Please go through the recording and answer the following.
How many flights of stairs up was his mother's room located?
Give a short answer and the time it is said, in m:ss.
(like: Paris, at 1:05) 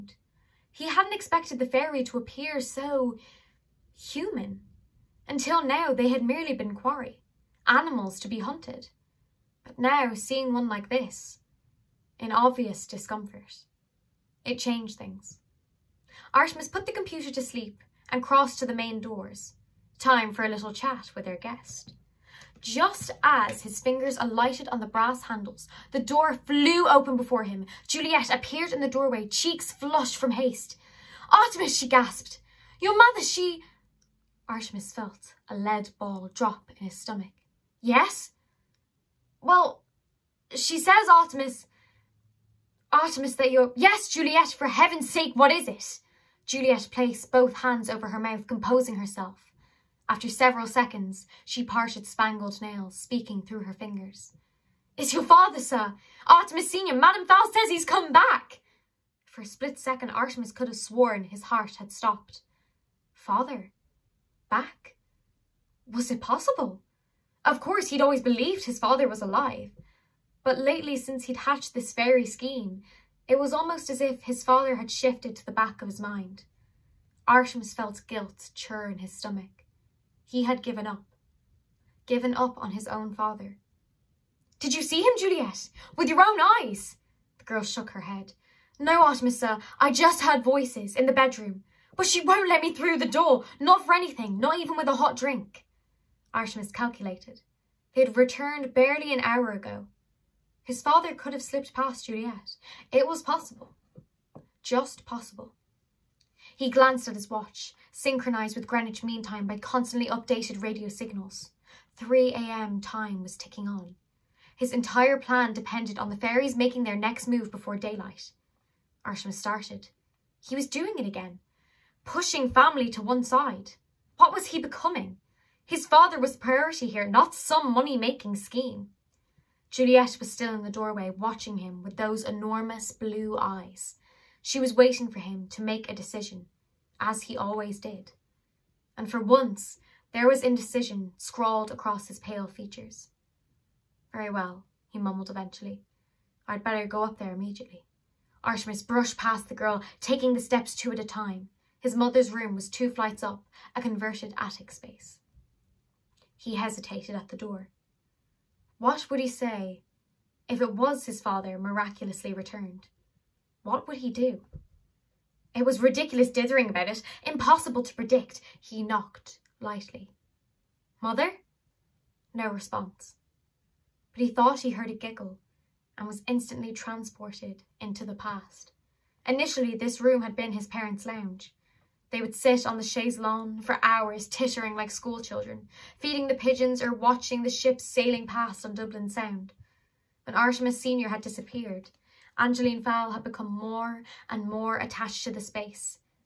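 2, at 2:32.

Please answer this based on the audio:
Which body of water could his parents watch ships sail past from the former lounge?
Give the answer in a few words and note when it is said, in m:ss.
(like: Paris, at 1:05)
Dublin Sound, at 3:08.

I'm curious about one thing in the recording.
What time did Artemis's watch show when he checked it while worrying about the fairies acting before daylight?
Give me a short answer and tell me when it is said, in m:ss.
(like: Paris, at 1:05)
3 a.m., at 1:51.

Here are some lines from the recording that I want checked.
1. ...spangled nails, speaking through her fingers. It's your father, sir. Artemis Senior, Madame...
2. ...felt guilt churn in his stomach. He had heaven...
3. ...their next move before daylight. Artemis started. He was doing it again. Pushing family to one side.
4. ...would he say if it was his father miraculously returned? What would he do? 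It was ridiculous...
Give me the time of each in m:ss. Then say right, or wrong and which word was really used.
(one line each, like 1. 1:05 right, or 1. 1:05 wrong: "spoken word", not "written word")
1. 0:52 right
2. 1:17 wrong: "given", not "heaven"
3. 1:56 right
4. 2:39 right.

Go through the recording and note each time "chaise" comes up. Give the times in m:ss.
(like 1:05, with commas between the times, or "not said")
3:02.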